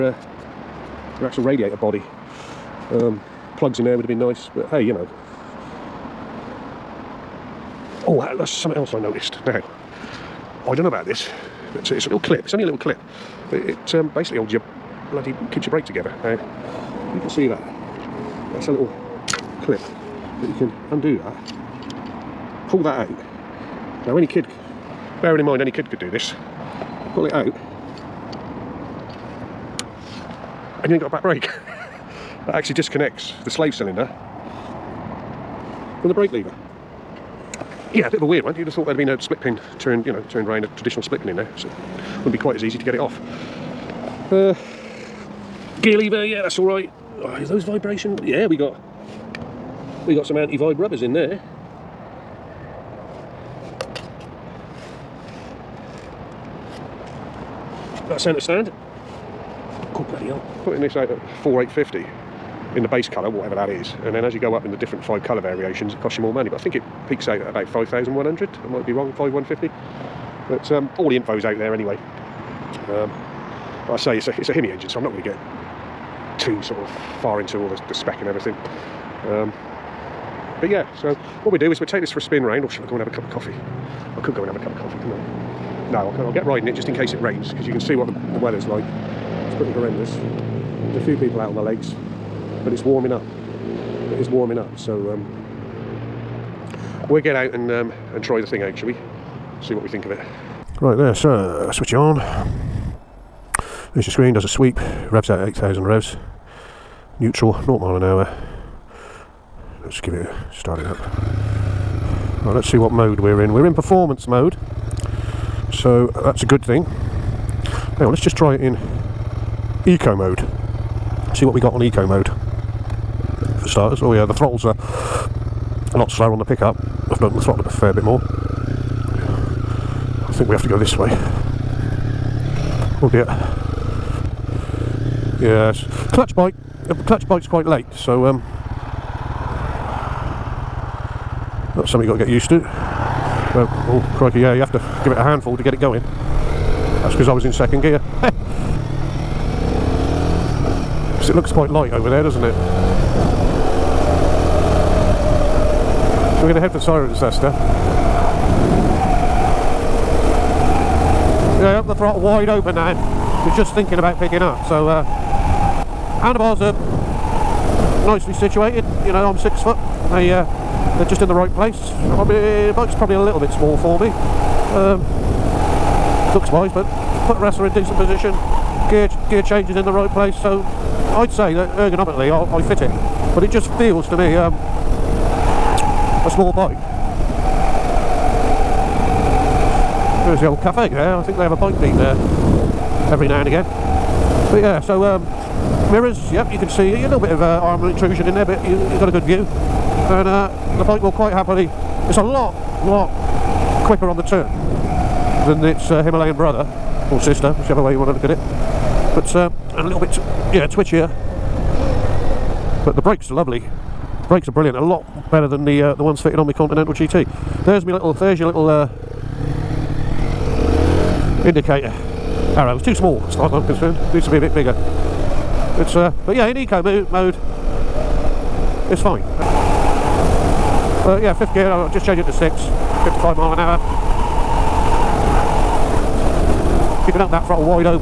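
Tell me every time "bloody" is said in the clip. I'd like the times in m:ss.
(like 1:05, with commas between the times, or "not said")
0:15, 1:00.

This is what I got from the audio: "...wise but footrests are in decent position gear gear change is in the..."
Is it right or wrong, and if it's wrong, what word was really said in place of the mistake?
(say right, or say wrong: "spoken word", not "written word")
right.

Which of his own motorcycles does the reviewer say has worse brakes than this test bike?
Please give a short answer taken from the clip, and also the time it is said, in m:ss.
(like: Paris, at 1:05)
Continental GT, at 3:36.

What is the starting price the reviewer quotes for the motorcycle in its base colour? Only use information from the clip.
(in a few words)
4850.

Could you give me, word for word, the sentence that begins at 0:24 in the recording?
Now, any kid, bearing in mind, any kid could do this.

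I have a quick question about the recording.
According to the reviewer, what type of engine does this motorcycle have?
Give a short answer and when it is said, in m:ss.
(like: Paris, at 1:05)
Hemi, at 1:14.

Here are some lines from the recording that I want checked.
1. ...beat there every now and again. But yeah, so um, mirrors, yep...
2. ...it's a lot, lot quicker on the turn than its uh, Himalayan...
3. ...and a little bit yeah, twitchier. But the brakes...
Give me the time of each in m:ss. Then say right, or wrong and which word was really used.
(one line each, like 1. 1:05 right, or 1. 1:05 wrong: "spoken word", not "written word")
1. 3:11 right
2. 3:22 right
3. 3:29 right.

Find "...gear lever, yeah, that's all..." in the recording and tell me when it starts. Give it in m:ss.
0:45.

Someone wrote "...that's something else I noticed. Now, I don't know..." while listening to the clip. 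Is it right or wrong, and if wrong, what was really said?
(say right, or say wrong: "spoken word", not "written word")
right.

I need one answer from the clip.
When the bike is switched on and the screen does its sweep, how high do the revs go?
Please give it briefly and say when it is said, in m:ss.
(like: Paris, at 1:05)
8,000 revs, at 1:45.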